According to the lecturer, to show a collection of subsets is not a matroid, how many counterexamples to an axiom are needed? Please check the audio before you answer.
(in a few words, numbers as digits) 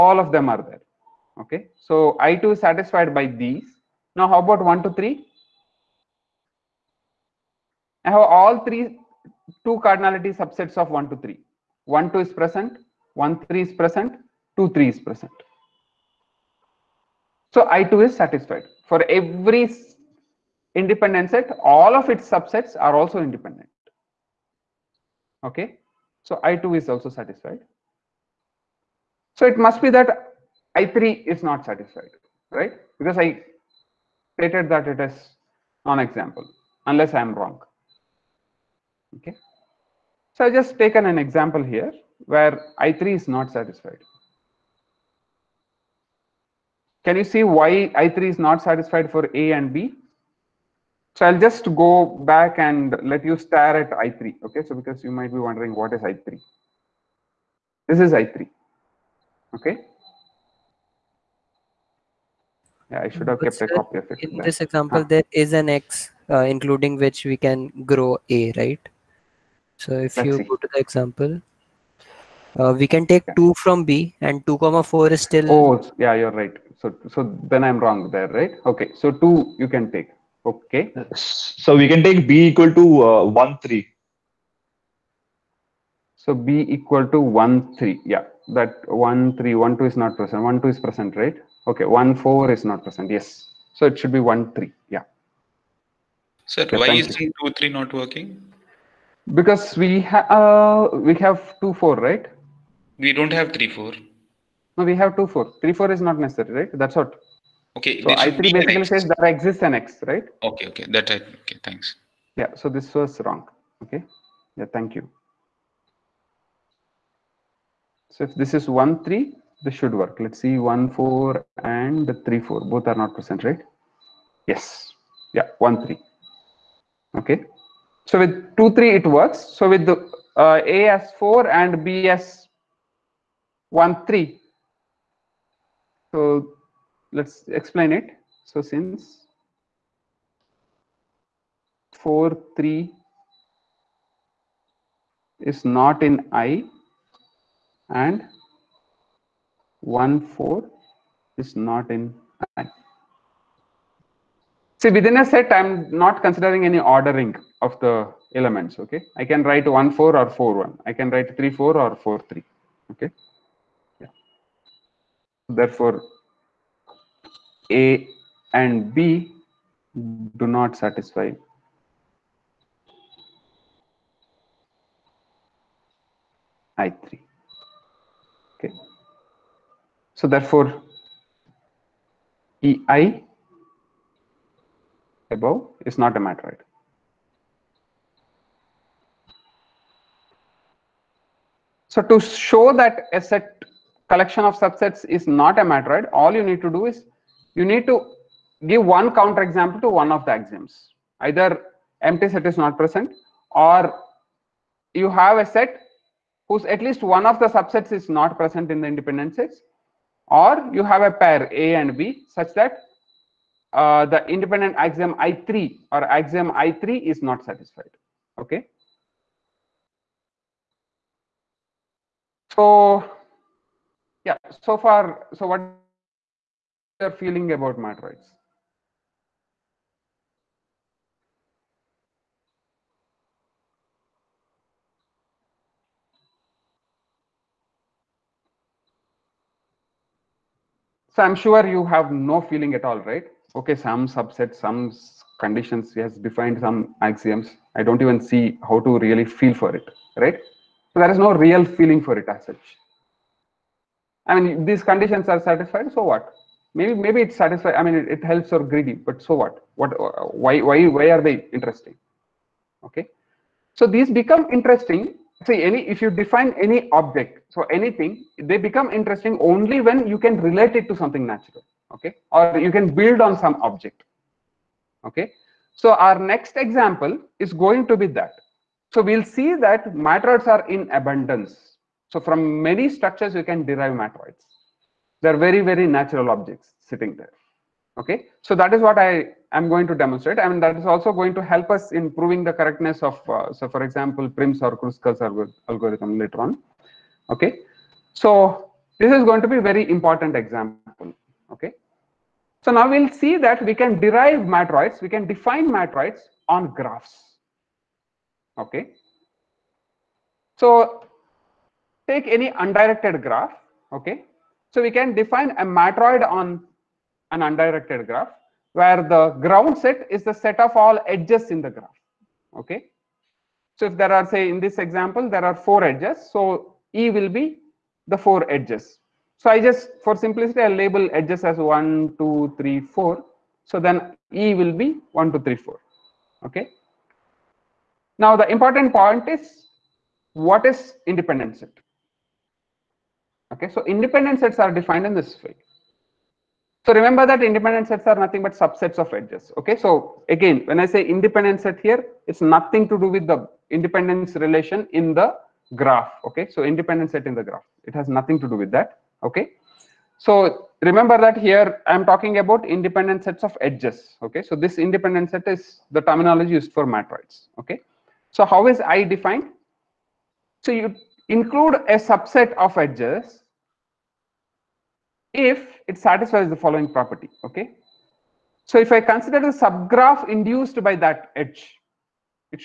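1.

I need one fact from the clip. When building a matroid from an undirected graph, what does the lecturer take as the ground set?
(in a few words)
the set of all edges.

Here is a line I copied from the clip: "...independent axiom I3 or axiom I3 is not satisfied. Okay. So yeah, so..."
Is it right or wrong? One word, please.
right.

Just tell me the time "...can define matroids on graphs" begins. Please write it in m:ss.
5:05.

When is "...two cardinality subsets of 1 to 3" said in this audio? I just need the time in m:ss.
0:09.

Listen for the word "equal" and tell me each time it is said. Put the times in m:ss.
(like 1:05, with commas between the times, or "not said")
1:22, 1:26.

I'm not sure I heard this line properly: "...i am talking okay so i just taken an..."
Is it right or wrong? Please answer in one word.
wrong.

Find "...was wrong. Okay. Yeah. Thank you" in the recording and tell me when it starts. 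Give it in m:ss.
1:52.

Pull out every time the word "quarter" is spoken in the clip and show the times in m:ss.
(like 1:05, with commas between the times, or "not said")
not said.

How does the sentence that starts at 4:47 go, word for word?
Okay, so that is what I am going to demonstrate.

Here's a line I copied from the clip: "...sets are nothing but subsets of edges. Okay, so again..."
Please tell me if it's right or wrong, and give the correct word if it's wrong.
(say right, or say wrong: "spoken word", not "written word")
right.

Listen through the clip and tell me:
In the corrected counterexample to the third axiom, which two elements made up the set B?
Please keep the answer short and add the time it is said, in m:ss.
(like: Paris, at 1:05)
1, 3, at 2:11.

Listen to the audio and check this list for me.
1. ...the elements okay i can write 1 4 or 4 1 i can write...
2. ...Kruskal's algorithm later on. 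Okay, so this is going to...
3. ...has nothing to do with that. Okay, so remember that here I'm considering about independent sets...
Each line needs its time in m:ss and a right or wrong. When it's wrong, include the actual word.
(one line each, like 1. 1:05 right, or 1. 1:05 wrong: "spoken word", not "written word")
1. 2:37 right
2. 4:54 right
3. 5:57 wrong: "talking", not "considering".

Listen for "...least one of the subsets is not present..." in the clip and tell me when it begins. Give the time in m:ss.
3:26.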